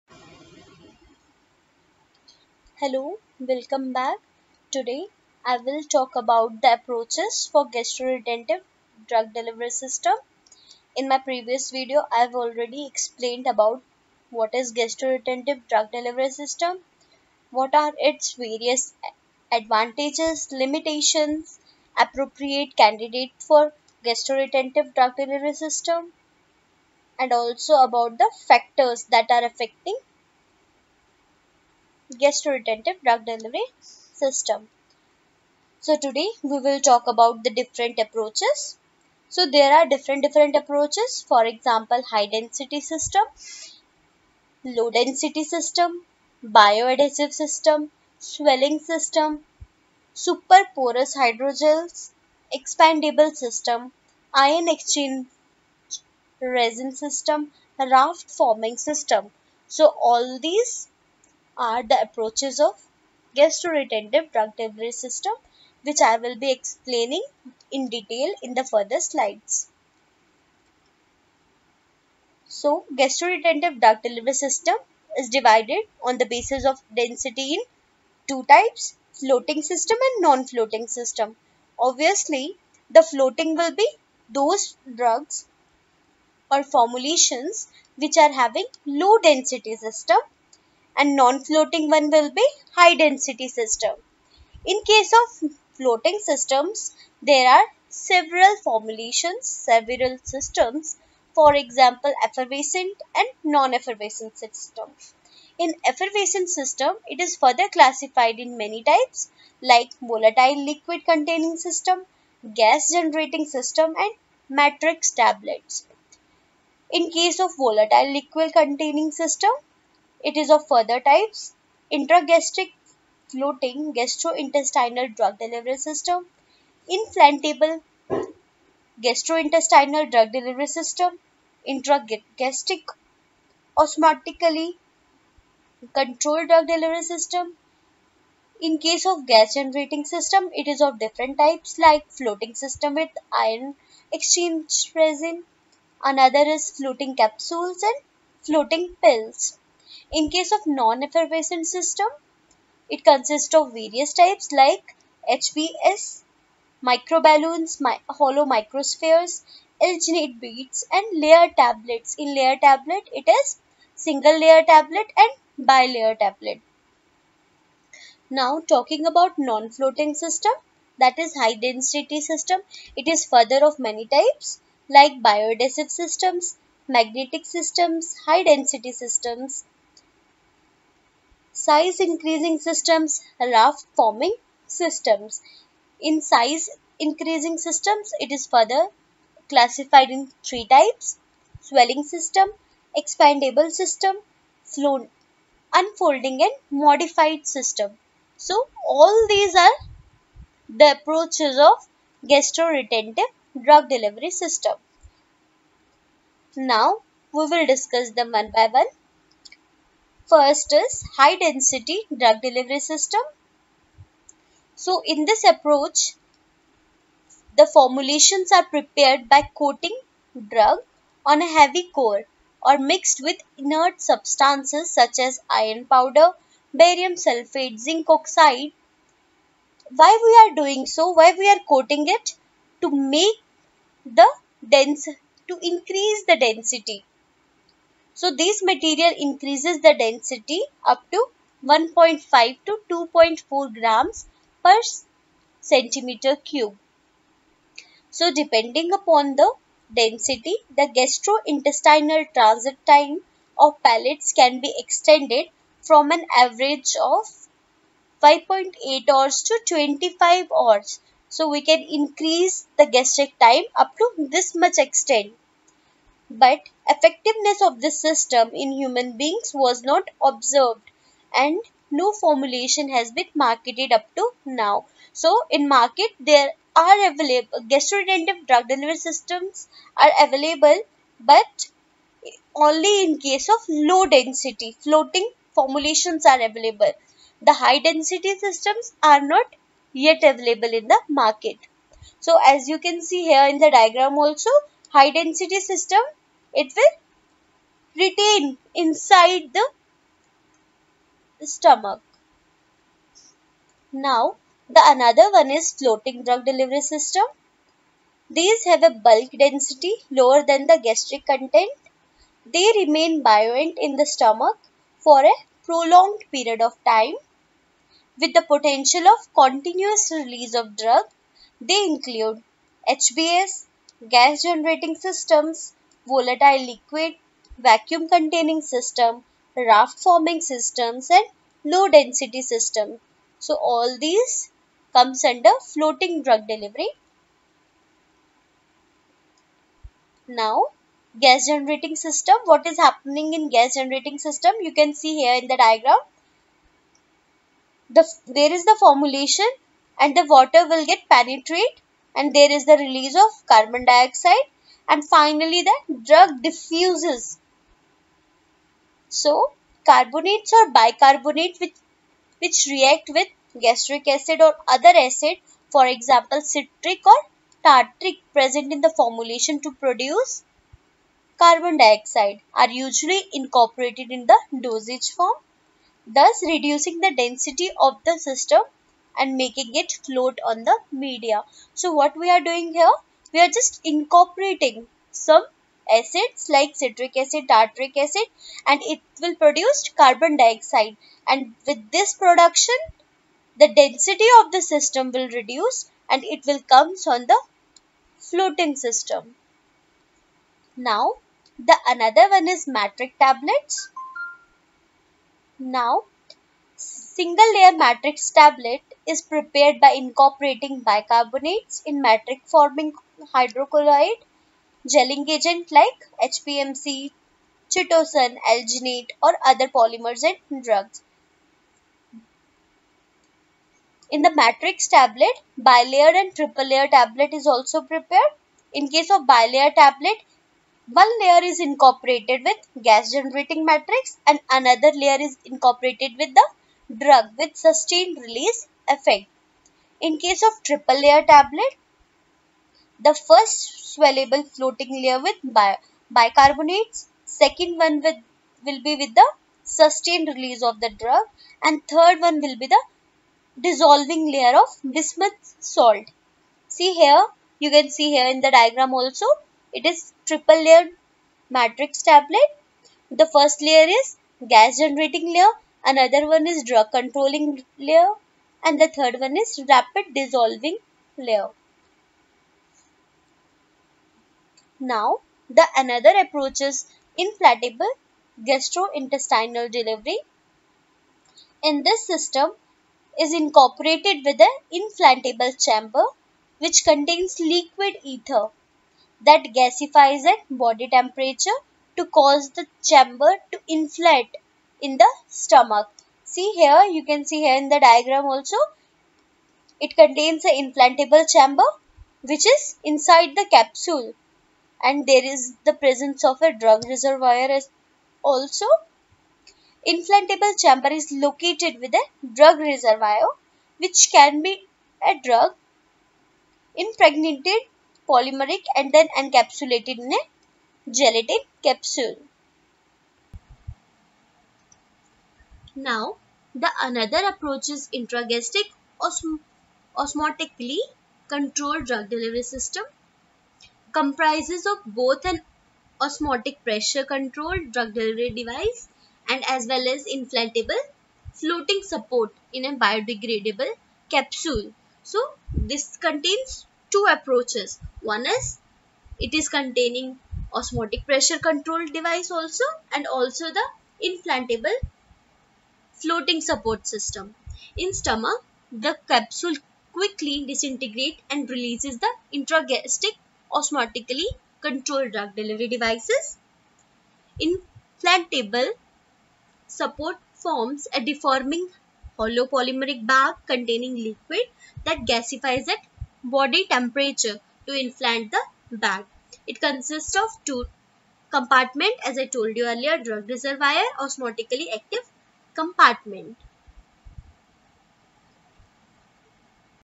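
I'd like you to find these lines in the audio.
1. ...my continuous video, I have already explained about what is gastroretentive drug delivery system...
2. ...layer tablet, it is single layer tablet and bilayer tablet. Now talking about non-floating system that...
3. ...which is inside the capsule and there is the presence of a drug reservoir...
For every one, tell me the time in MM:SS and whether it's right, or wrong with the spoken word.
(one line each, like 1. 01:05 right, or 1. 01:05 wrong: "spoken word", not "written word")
1. 00:11 wrong: "previous", not "continuous"
2. 02:42 right
3. 08:22 right.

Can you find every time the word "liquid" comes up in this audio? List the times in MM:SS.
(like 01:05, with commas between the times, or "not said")
01:50, 01:58, 05:26, 08:07, 09:33.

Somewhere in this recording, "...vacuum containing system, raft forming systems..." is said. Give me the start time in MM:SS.
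05:27.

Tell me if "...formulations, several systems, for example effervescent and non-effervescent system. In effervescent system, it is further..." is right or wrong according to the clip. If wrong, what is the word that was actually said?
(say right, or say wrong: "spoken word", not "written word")
right.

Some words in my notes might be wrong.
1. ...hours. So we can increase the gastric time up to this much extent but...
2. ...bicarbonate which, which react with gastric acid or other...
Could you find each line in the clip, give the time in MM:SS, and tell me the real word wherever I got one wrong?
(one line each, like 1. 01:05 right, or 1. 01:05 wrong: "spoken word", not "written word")
1. 04:20 right
2. 06:00 right.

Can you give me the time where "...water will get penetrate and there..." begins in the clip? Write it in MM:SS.
05:50.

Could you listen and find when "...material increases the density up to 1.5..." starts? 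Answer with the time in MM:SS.
03:58.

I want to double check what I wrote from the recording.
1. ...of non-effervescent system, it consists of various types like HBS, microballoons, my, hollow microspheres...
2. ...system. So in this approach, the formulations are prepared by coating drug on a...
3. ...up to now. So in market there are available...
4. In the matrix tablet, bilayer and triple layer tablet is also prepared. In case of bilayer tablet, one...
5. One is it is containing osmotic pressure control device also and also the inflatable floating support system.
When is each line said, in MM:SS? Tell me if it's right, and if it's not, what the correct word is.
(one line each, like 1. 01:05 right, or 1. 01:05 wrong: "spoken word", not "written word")
1. 02:30 right
2. 03:32 right
3. 04:33 right
4. 07:04 right
5. 09:08 right.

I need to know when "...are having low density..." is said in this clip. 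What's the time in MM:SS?
01:28.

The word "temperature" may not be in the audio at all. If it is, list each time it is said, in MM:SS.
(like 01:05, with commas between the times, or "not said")
08:10, 09:36.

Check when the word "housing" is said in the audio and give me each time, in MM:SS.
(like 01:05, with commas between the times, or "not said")
not said.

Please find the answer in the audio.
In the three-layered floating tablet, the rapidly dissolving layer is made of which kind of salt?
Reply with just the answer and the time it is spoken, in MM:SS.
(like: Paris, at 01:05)
bismuth salt, at 07:34.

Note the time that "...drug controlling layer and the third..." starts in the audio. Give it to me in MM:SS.
07:46.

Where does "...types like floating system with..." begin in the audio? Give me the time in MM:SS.
02:21.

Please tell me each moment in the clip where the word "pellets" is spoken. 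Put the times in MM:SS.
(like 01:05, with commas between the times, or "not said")
04:13.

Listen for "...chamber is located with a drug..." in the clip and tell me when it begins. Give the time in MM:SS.
08:30.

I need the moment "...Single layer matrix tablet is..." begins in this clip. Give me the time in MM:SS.
06:47.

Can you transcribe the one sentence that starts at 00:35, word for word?
So today we will talk about the different approaches.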